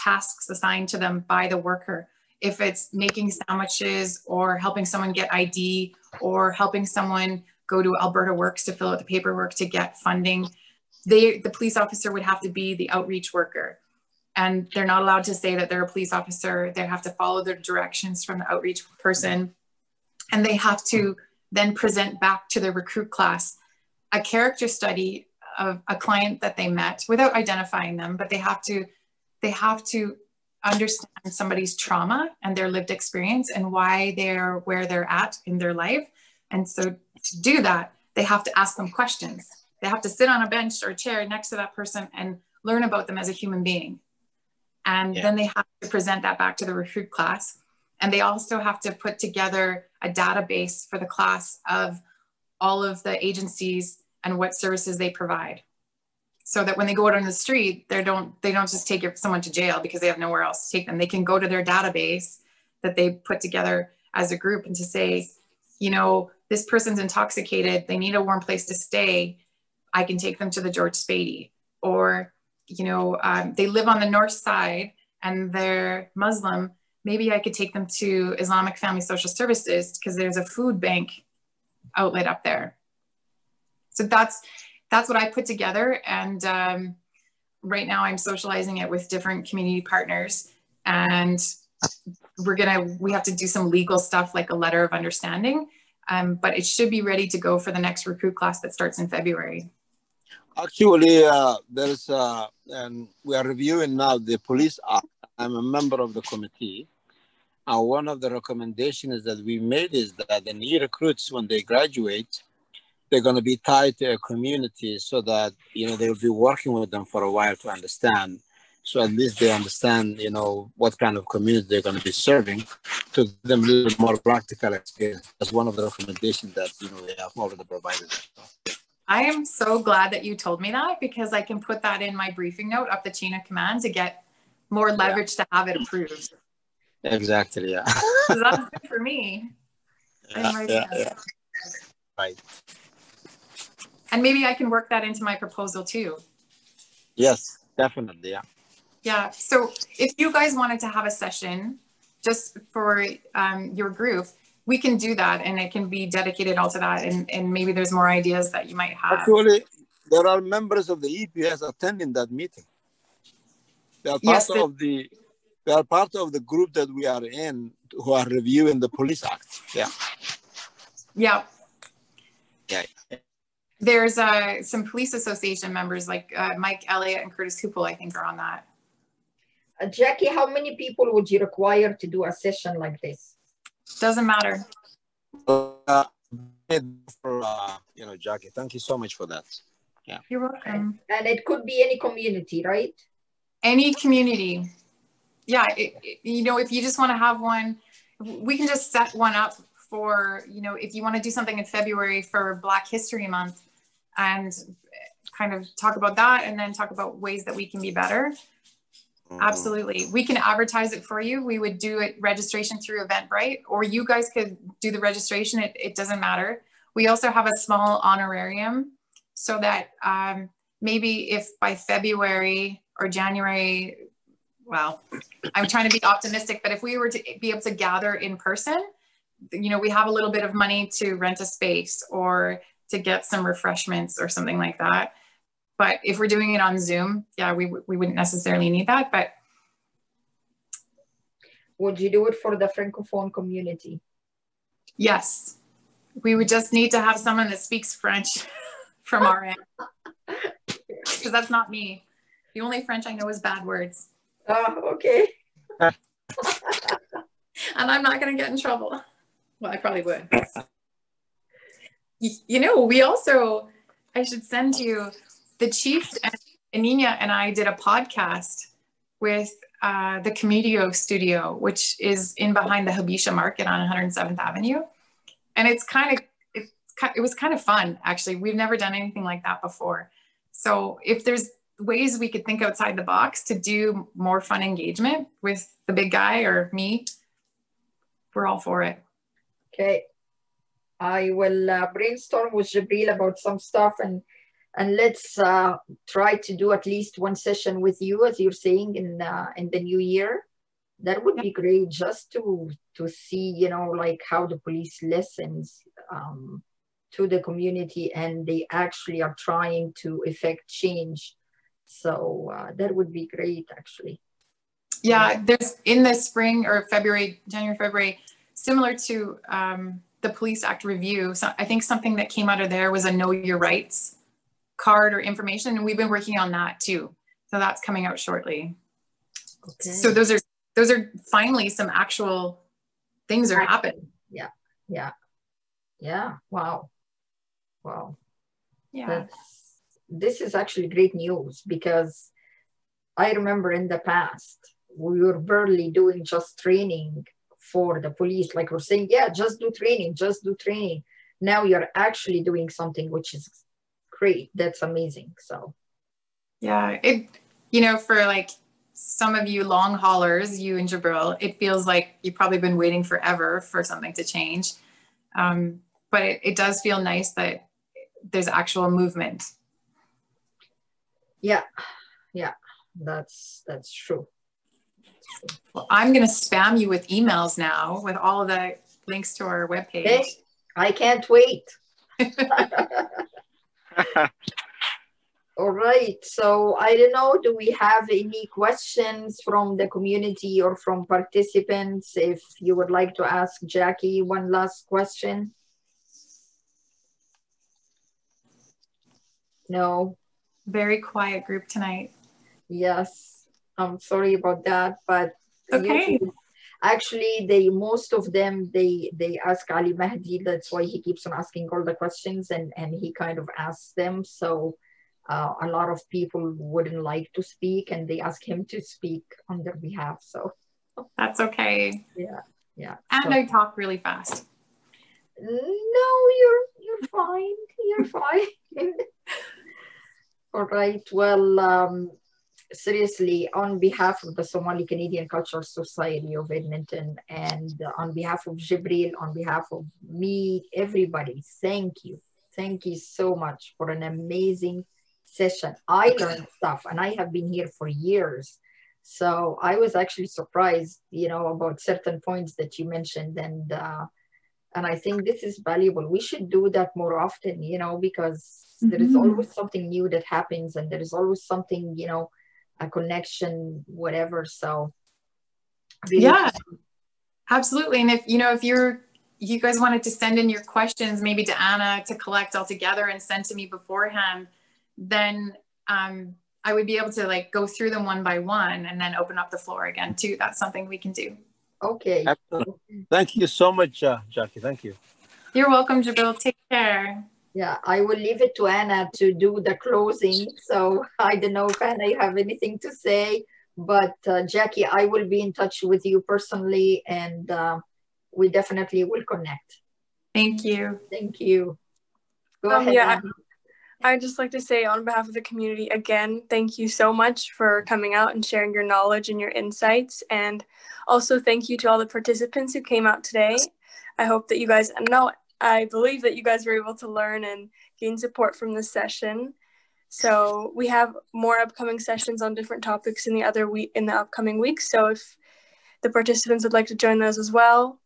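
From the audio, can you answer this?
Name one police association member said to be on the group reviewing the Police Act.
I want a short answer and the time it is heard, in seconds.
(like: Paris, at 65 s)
Mike Elliott, at 176 s.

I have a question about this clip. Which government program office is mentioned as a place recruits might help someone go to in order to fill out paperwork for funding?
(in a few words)
Alberta Works.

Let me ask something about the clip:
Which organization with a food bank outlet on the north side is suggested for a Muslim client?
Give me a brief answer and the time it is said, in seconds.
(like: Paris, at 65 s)
Islamic Family Social Services, at 78 s.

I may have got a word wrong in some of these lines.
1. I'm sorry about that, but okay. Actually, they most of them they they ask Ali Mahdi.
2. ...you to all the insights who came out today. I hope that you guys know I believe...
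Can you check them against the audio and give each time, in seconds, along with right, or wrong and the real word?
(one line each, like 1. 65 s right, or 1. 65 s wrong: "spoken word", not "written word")
1. 403 s right
2. 511 s wrong: "participants", not "insights".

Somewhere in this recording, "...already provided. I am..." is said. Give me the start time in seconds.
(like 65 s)
127 s.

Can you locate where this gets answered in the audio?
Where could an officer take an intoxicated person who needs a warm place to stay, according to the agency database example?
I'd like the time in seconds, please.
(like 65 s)
70 s.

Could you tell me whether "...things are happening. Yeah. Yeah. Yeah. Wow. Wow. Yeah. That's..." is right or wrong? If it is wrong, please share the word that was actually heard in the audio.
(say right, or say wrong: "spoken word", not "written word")
right.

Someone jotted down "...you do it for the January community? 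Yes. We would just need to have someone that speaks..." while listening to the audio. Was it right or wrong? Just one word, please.
wrong.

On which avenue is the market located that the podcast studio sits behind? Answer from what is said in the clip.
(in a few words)
107th Avenue.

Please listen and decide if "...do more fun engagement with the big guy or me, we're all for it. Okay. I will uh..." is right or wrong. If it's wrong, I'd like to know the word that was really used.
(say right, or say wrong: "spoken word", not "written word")
right.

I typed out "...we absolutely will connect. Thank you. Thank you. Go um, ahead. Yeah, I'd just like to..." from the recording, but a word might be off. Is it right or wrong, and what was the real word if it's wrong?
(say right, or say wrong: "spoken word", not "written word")
wrong: "definitely", not "absolutely".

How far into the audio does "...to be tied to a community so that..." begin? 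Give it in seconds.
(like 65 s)
113 s.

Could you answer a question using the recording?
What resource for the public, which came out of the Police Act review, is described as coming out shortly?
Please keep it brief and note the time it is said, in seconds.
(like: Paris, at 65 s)
know your rights card, at 323 s.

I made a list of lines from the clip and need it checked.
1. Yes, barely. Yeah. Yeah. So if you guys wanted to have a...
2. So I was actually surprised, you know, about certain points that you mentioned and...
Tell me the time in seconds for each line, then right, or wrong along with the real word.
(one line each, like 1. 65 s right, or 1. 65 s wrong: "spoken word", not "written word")
1. 147 s wrong: "definitely", not "barely"
2. 449 s right.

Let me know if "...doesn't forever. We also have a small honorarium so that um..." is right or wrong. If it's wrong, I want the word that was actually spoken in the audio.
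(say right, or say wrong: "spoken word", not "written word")
wrong: "matter", not "forever".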